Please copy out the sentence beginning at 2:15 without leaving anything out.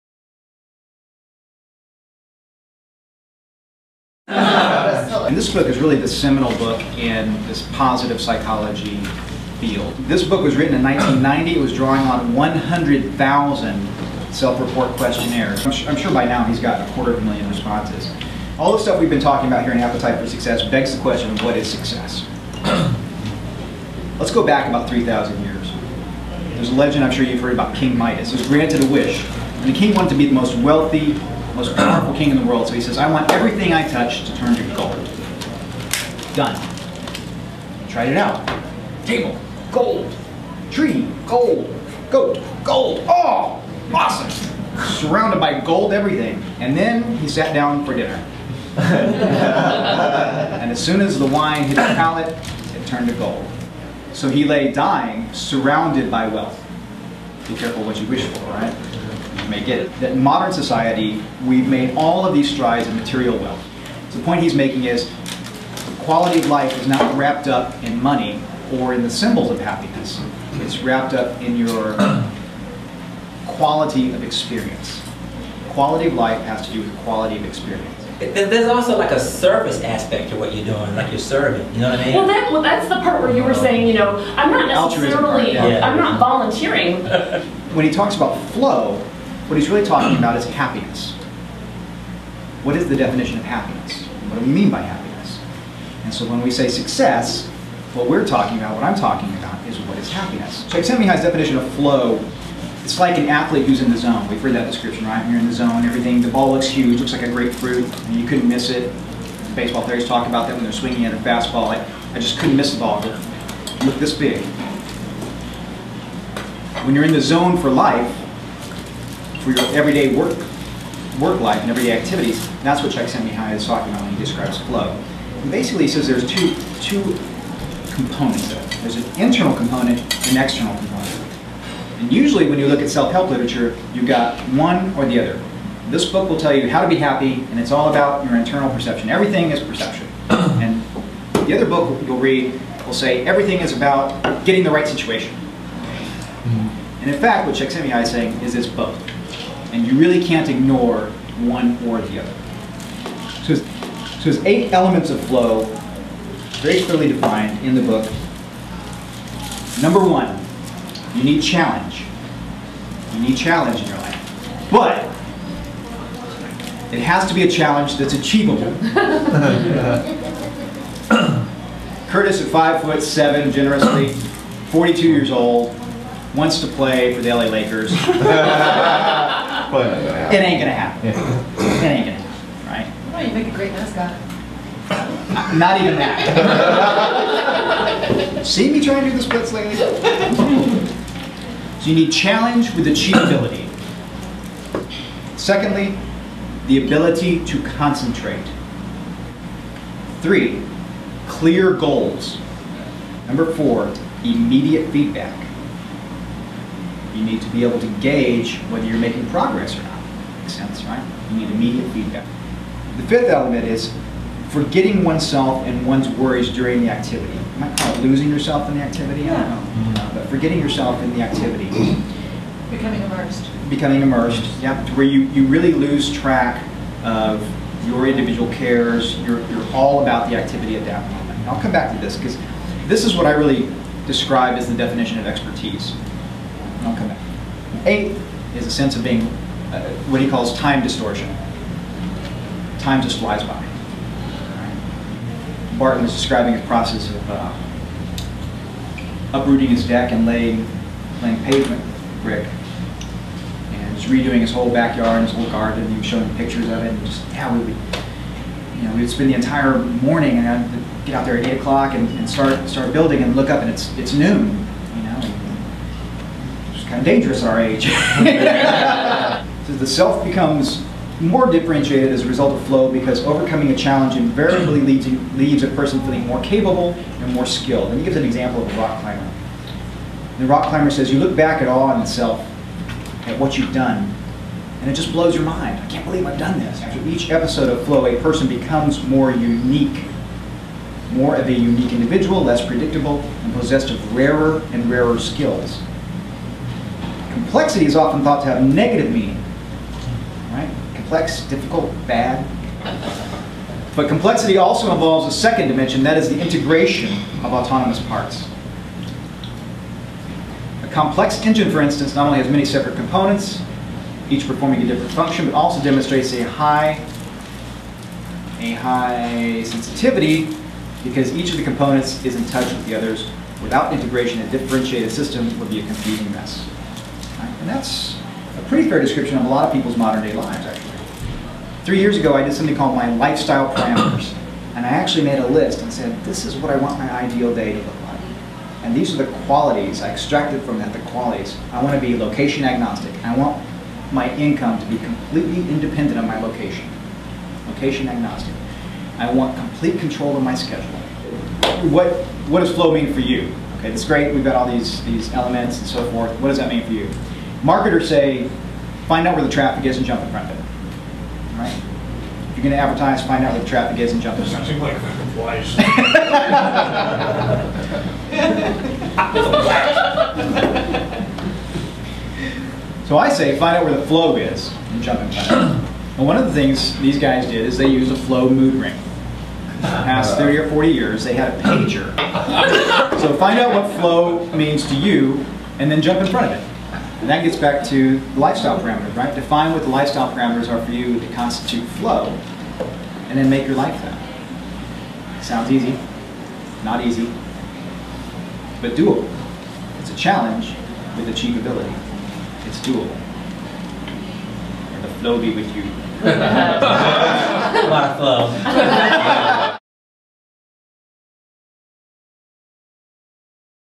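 This book will tell you how to be happy, and it's all about your internal perception.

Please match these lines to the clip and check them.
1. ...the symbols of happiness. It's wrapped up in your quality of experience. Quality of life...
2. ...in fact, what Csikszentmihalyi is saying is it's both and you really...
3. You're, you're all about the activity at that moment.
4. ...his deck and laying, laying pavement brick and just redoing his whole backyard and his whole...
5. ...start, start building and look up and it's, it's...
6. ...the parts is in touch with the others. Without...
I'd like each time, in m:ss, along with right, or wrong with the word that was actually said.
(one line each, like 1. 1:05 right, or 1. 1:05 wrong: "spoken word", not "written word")
1. 1:09 right
2. 2:27 right
3. 3:49 right
4. 4:09 right
5. 4:22 right
6. 5:21 wrong: "components", not "parts".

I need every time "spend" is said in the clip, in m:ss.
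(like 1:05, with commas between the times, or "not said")
4:19.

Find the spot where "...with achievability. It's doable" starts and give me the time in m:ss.
6:41.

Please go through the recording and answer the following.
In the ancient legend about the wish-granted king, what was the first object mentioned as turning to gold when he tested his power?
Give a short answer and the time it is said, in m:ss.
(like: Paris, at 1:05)
Table, at 0:39.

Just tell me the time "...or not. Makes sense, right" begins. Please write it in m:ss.
3:29.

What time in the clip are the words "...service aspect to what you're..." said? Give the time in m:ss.
1:19.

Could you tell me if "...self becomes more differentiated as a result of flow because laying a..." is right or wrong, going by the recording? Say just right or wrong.
wrong.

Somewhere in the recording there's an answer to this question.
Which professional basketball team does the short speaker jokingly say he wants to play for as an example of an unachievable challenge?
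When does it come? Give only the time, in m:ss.
2:57.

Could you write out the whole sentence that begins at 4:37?
And he gives an example of a rock climber.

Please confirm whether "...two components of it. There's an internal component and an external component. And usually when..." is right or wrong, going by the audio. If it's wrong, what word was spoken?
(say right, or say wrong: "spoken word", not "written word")
right.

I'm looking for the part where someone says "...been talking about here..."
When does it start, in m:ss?
0:19.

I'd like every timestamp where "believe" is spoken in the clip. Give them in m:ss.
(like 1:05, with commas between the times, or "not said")
4:46.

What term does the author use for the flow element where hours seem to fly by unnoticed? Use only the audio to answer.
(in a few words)
Time distortion.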